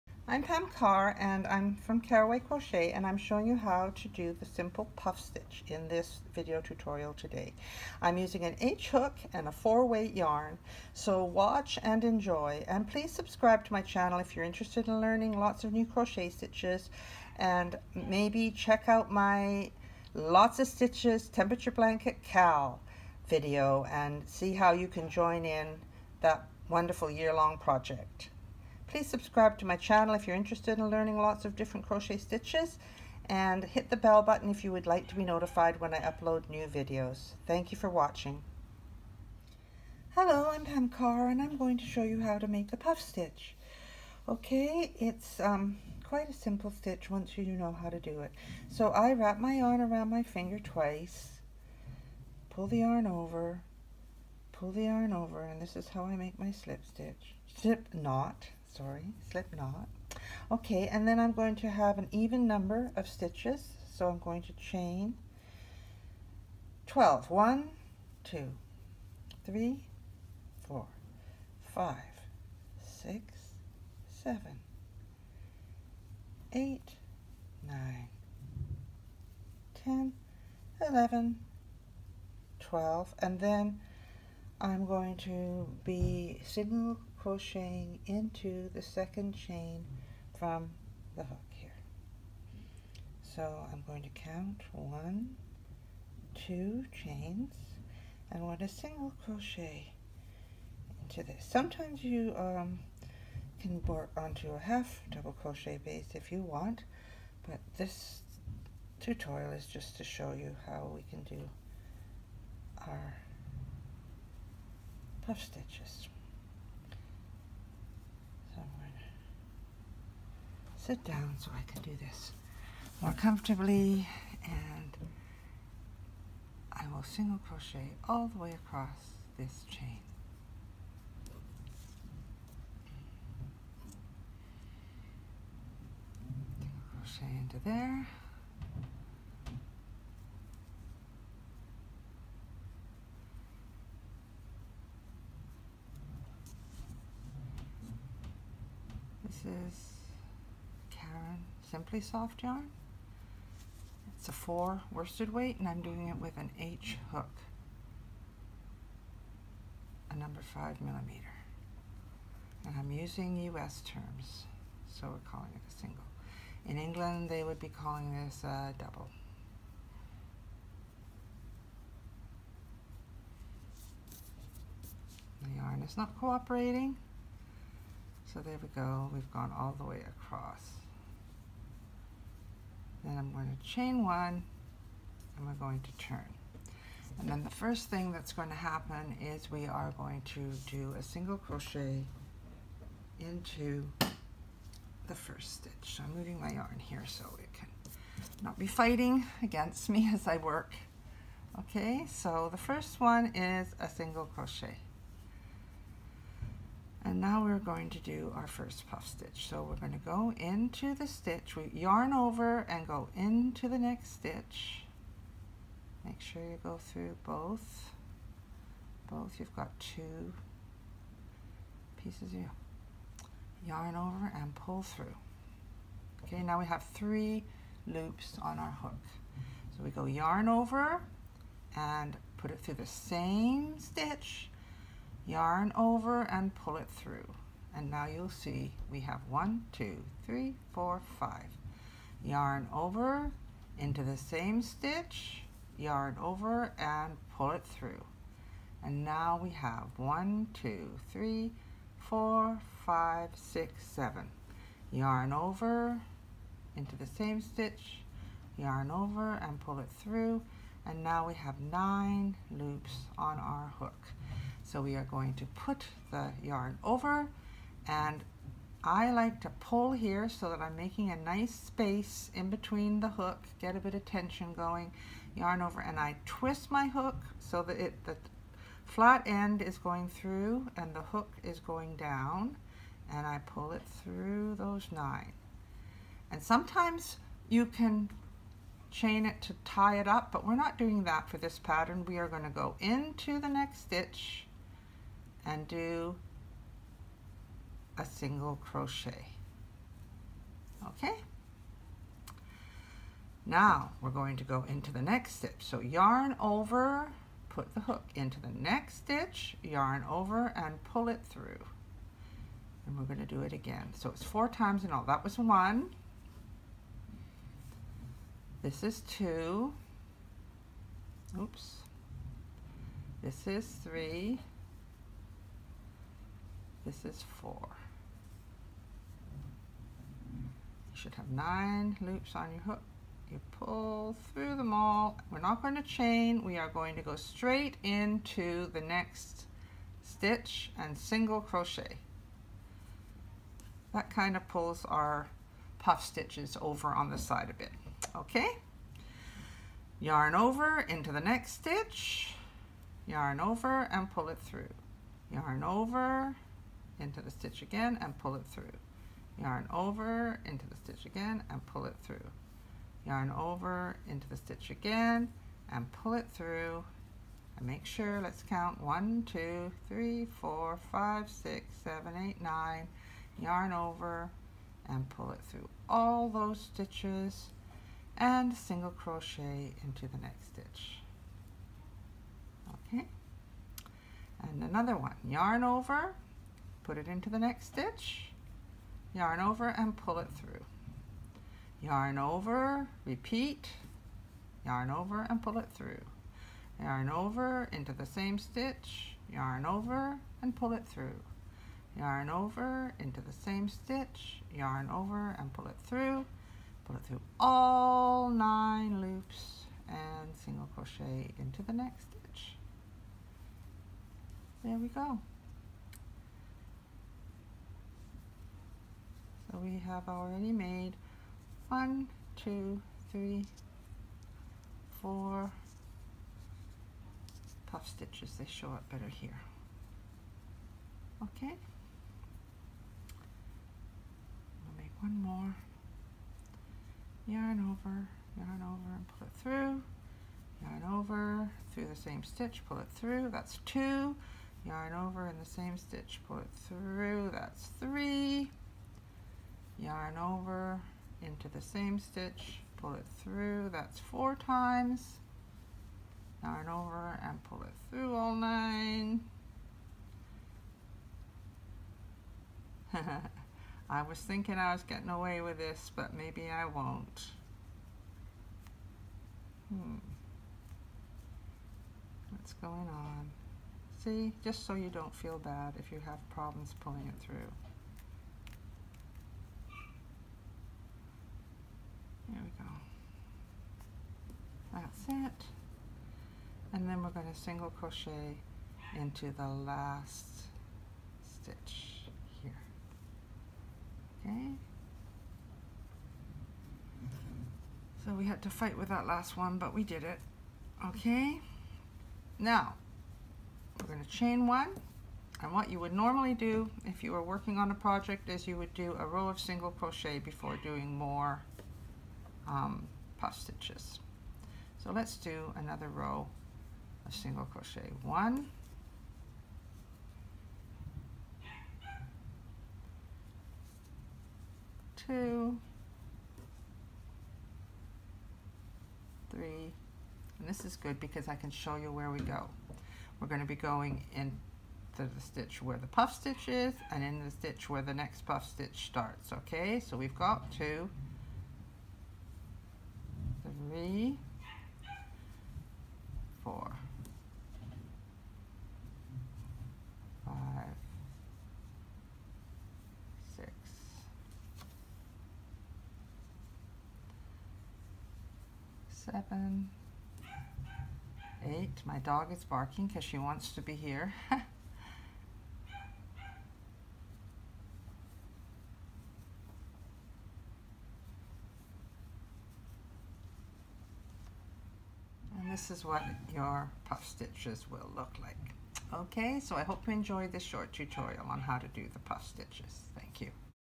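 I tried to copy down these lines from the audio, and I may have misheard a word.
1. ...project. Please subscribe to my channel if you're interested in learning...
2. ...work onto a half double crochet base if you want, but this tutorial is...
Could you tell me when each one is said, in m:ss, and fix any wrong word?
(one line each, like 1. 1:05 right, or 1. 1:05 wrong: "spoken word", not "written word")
1. 0:27 right
2. 1:43 right.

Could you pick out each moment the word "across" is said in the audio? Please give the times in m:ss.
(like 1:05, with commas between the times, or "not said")
2:08, 3:00.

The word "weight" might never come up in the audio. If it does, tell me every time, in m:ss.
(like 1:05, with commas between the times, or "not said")
0:09, 2:35.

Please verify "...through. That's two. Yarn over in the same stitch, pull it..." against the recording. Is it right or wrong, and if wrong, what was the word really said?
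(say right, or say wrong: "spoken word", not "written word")
right.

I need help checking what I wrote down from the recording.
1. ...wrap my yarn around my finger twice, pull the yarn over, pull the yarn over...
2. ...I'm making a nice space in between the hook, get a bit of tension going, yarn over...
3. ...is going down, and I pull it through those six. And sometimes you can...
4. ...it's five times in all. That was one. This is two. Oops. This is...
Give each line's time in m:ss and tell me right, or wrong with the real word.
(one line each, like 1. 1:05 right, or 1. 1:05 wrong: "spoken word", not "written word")
1. 0:49 right
2. 4:30 right
3. 4:41 wrong: "nine", not "six"
4. 5:14 wrong: "four", not "five".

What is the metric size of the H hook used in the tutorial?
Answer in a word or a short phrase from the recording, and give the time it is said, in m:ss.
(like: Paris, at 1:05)
5 millimeter, at 2:40.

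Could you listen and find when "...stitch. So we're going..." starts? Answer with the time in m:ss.
3:29.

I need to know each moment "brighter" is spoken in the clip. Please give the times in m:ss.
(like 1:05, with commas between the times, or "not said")
not said.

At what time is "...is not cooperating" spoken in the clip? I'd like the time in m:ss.
2:55.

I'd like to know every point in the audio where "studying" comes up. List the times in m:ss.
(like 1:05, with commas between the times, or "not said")
not said.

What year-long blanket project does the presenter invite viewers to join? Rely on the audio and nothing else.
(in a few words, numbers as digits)
temperature blanket Cal.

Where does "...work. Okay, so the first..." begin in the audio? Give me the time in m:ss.
3:20.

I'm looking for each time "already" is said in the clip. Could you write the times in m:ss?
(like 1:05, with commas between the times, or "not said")
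7:00.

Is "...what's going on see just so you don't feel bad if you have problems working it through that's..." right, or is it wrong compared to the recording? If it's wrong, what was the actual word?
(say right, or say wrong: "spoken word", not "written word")
wrong: "pulling", not "working".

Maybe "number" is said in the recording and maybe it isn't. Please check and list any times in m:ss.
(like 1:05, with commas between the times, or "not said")
1:02, 2:40.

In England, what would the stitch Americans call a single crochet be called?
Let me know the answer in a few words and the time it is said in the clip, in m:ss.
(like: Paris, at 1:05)
a double, at 2:48.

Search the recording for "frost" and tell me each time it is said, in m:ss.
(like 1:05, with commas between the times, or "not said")
not said.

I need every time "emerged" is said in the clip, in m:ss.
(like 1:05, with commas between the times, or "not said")
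not said.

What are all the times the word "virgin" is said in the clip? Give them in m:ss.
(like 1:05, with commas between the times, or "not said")
not said.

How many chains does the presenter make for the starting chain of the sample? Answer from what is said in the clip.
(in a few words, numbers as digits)
12.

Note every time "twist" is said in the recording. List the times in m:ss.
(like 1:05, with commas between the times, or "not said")
4:36.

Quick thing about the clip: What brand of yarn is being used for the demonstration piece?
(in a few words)
Simply Soft.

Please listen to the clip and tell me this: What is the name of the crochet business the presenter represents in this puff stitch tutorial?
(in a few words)
Carroway Crochet.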